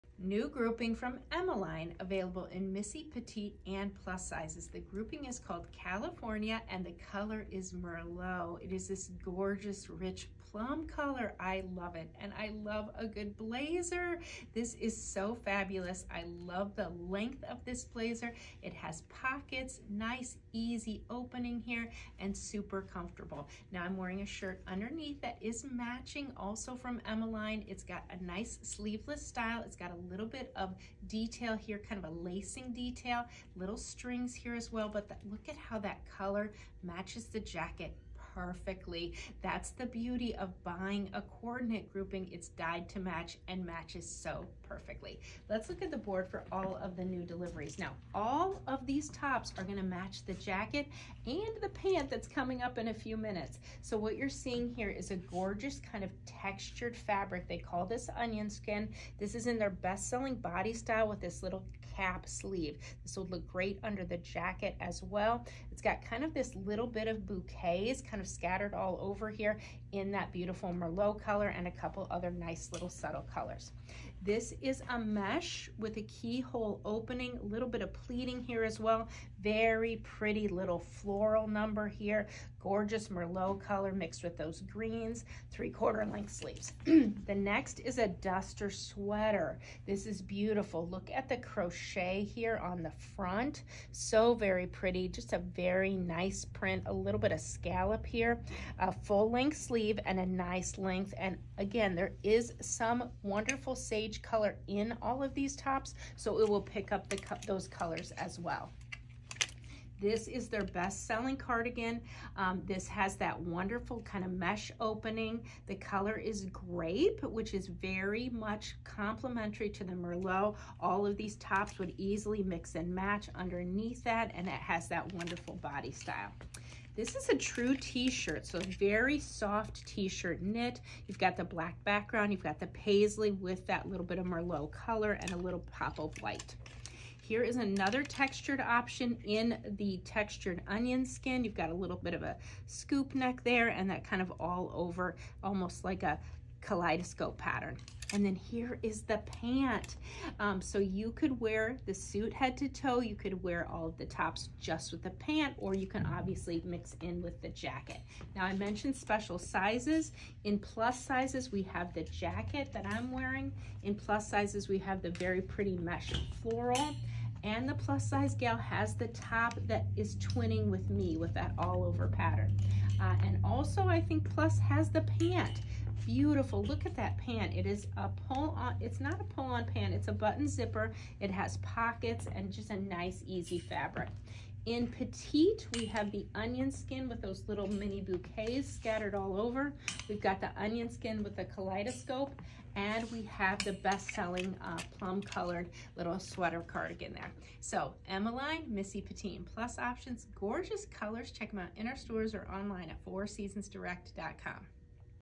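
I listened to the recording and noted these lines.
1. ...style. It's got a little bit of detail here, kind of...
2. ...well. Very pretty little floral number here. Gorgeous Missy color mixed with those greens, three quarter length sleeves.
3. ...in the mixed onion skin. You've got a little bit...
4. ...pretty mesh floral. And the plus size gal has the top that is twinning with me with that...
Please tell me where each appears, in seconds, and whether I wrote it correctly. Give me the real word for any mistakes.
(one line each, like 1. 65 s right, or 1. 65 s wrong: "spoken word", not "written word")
1. 29 s right
2. 78 s wrong: "Merlot", not "Missy"
3. 139 s wrong: "textured", not "mixed"
4. 165 s right.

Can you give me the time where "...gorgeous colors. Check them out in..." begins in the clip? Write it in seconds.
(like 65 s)
200 s.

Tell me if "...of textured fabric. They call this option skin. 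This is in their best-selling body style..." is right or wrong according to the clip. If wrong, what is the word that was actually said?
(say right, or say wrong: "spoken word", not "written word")
wrong: "onion", not "option".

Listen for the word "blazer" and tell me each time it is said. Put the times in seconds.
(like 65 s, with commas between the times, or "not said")
13 s, 17 s.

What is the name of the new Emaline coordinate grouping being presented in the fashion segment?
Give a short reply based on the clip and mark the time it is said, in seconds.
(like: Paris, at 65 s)
California, at 5 s.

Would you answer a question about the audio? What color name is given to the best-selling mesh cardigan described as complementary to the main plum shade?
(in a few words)
grape.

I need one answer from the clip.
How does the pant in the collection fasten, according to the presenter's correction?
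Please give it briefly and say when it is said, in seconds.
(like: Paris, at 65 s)
button zipper, at 180 s.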